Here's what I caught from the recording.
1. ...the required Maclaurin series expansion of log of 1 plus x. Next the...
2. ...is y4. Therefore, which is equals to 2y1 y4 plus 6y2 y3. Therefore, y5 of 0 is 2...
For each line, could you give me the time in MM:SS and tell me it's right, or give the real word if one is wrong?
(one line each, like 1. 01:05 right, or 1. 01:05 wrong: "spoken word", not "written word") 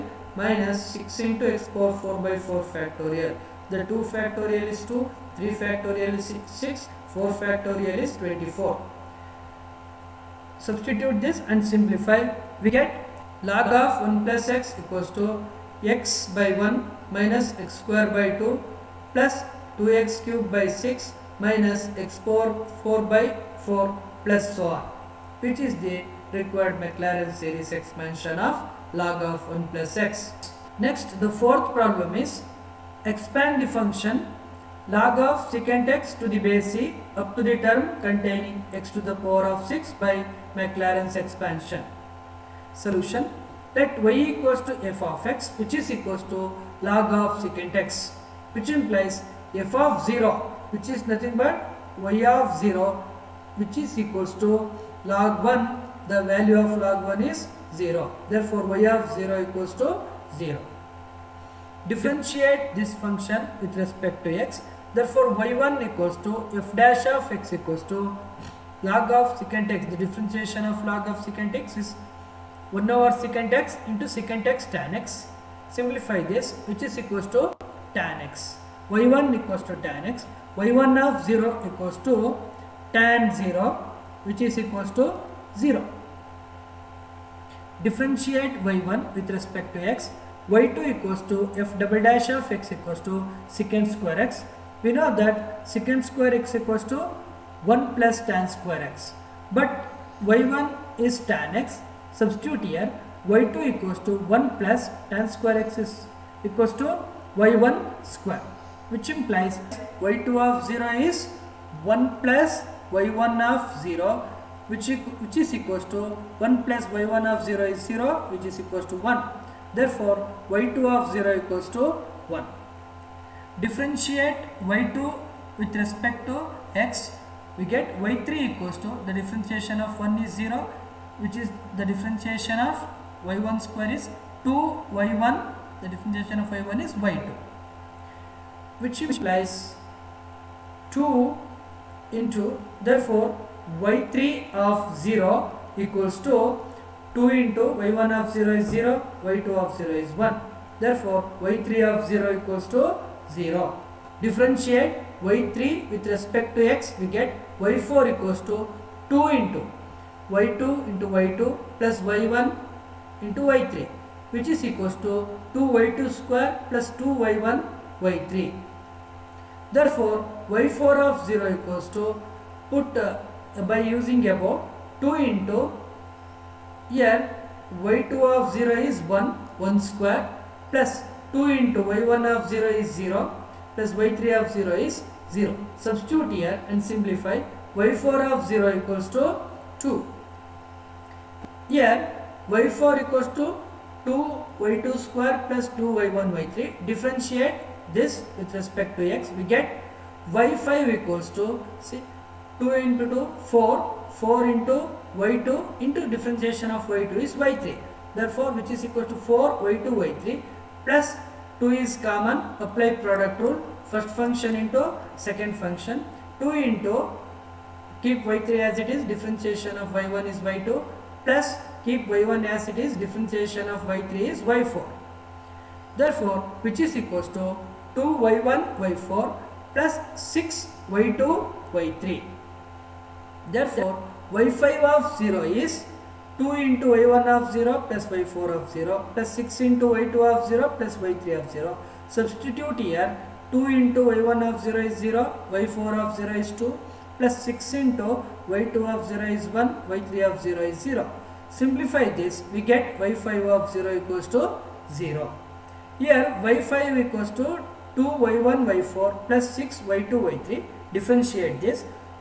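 1. 00:25 right
2. 03:44 right.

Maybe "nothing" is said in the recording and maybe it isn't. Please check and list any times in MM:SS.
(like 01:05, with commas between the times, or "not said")
00:51.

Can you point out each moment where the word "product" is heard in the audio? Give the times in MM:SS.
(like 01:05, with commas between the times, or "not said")
03:33.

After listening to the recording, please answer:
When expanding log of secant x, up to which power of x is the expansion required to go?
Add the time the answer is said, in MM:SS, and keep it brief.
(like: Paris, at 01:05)
6, at 00:38.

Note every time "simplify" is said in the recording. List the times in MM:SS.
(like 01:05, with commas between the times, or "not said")
00:11, 01:15, 03:06, 04:11.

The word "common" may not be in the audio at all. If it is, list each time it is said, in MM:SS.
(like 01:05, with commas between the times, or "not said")
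03:32.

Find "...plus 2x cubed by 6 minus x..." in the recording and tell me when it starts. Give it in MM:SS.
00:19.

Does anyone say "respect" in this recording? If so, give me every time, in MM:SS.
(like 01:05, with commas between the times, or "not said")
01:03, 01:29, 02:05, 02:36, 03:18.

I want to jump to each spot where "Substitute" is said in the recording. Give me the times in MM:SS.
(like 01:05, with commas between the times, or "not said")
00:10, 01:42, 03:05, 04:02.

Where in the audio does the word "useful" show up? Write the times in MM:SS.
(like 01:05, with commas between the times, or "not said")
not said.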